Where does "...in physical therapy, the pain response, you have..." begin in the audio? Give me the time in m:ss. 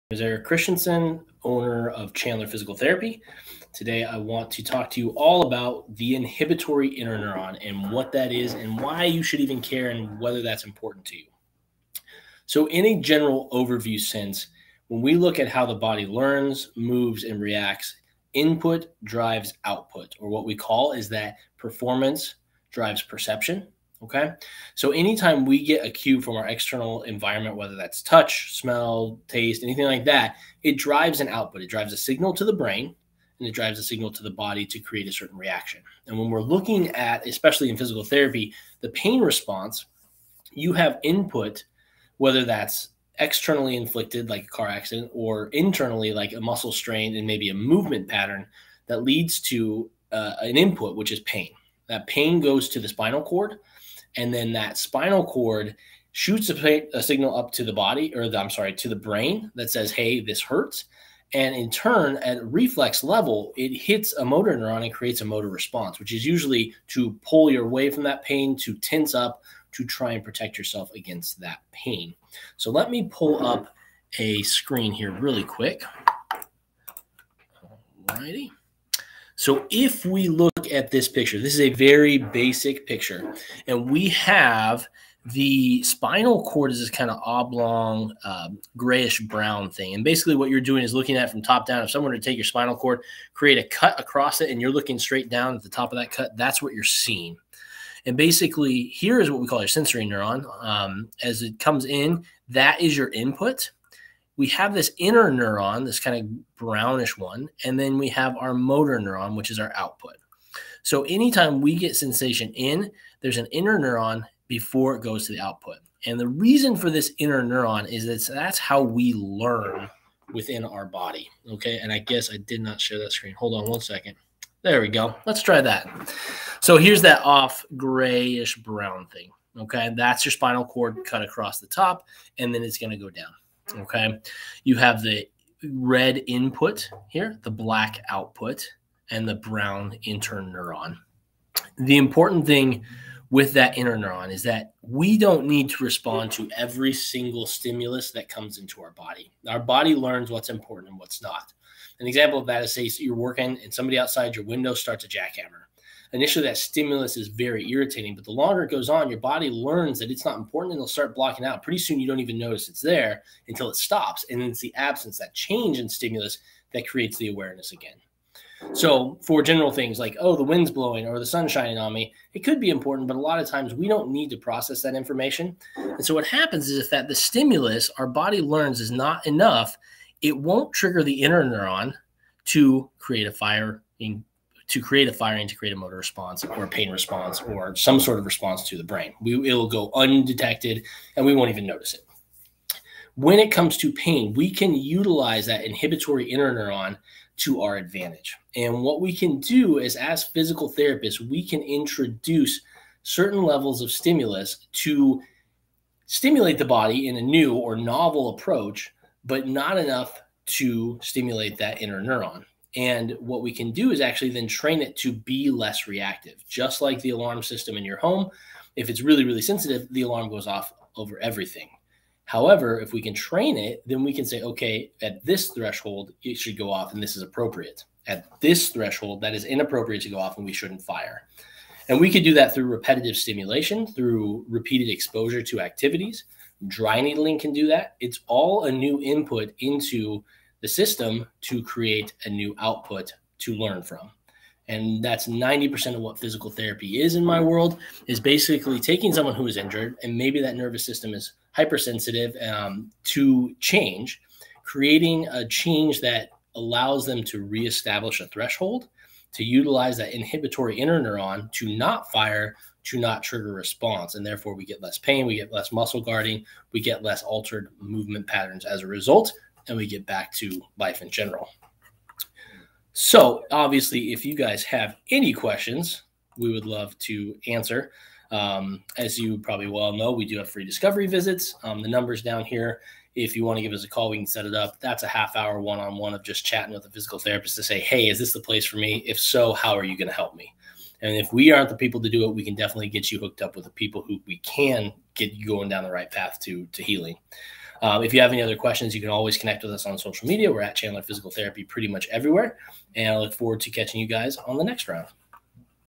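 0:37.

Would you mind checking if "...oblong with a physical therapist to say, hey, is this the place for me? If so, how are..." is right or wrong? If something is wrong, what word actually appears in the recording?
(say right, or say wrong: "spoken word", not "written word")
wrong: "chatting", not "oblong".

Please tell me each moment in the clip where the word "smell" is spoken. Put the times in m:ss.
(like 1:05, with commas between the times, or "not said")
0:28.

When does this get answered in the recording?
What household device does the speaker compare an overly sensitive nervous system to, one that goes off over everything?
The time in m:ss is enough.
3:37.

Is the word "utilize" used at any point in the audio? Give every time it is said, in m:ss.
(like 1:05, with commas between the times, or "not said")
3:14, 4:19.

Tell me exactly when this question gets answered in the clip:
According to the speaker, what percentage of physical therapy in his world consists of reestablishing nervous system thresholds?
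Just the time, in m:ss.
4:05.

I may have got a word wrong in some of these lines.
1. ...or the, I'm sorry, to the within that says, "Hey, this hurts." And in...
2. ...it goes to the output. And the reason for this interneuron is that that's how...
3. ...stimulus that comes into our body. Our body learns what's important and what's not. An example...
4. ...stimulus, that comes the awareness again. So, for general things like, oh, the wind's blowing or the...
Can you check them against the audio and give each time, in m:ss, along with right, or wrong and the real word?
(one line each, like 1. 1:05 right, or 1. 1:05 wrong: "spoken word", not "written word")
1. 0:58 wrong: "brain", not "within"
2. 1:54 right
3. 2:27 right
4. 2:45 wrong: "creates", not "comes".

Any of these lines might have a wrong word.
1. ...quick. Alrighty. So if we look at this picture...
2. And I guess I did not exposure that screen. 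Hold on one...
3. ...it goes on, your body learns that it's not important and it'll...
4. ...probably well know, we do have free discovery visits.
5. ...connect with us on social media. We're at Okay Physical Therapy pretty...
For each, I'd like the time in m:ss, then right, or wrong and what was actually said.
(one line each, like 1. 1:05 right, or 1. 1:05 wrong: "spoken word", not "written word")
1. 1:15 right
2. 2:01 wrong: "share", not "exposure"
3. 2:38 right
4. 4:39 right
5. 4:59 wrong: "Chandler", not "Okay".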